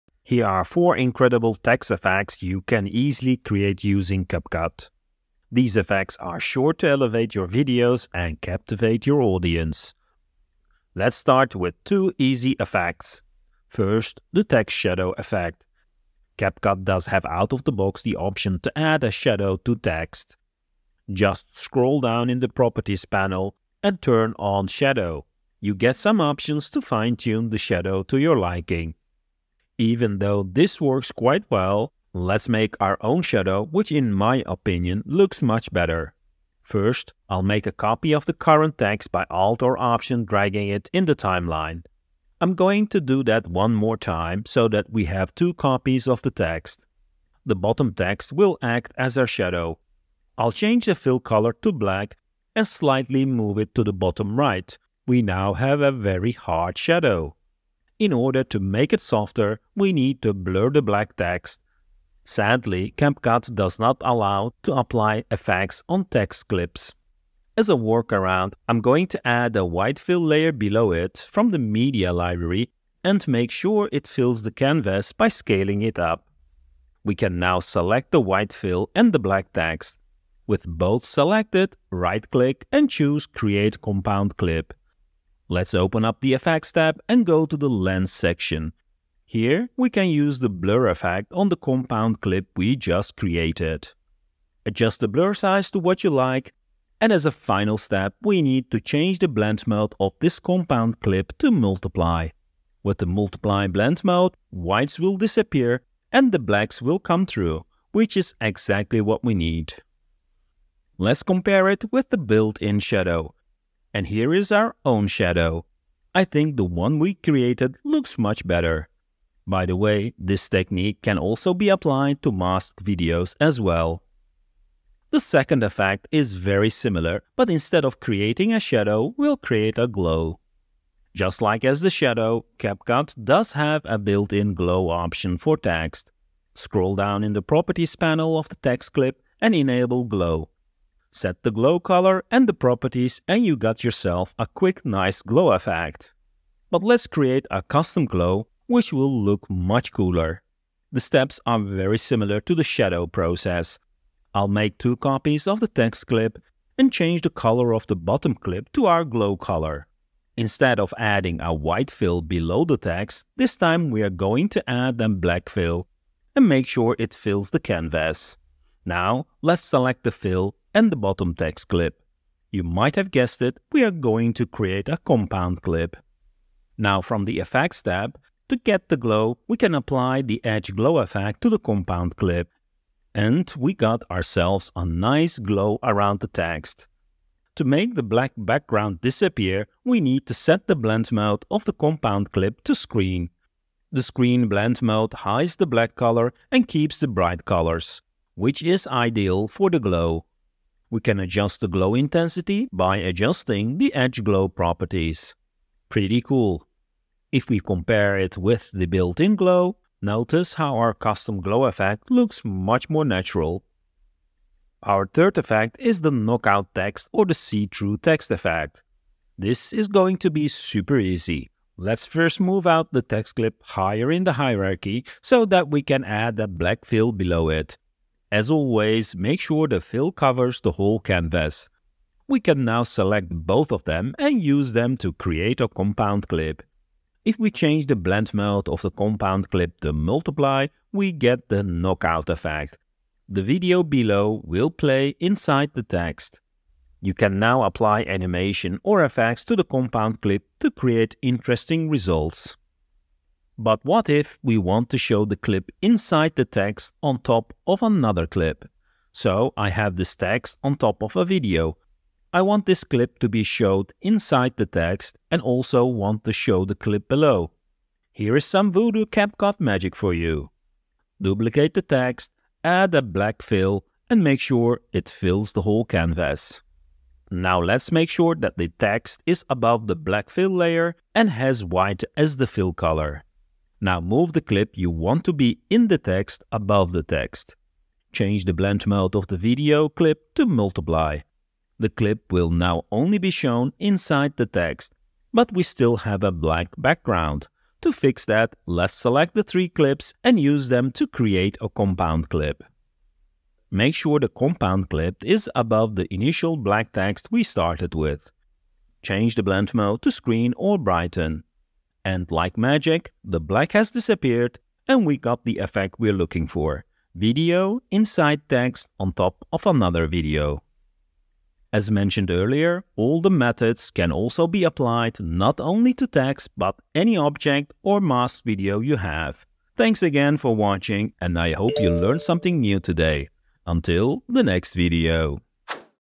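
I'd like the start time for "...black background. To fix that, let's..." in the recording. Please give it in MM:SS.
04:56.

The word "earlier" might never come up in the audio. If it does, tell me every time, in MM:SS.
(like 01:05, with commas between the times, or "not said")
05:22.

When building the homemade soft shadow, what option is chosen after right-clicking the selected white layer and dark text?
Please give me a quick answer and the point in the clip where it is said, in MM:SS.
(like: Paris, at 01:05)
Create Compound Clip, at 01:23.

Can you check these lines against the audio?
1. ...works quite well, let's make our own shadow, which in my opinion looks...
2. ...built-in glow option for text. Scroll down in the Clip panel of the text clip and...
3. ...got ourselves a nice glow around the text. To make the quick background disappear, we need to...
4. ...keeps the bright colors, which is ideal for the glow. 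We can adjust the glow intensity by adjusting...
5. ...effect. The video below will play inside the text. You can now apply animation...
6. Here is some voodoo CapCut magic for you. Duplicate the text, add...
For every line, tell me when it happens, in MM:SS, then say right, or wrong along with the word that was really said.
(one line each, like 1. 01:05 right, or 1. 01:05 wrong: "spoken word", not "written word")
1. 00:30 right
2. 02:13 wrong: "Properties", not "Clip"
3. 03:03 wrong: "black", not "quick"
4. 03:16 right
5. 04:02 right
6. 04:28 right.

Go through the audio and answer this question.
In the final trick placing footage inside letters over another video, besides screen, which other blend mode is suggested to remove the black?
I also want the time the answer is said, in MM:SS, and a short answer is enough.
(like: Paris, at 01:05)
brighten, at 05:10.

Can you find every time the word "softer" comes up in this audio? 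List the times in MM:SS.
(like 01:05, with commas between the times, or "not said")
00:58.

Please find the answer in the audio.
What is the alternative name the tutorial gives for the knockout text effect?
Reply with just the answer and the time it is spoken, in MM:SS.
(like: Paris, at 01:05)
see-through text, at 03:37.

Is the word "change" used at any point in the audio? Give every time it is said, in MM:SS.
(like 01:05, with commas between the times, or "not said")
00:50, 01:38, 02:36, 03:57, 04:48, 05:09.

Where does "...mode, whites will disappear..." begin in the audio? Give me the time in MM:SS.
01:44.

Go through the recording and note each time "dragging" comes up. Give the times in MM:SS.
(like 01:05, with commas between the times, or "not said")
00:40.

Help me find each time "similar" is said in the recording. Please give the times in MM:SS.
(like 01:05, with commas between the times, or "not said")
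02:06, 02:31.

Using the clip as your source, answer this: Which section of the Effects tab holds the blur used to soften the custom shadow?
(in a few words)
Lens.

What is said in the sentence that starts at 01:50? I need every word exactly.
Let's compare it with the built-in shadow.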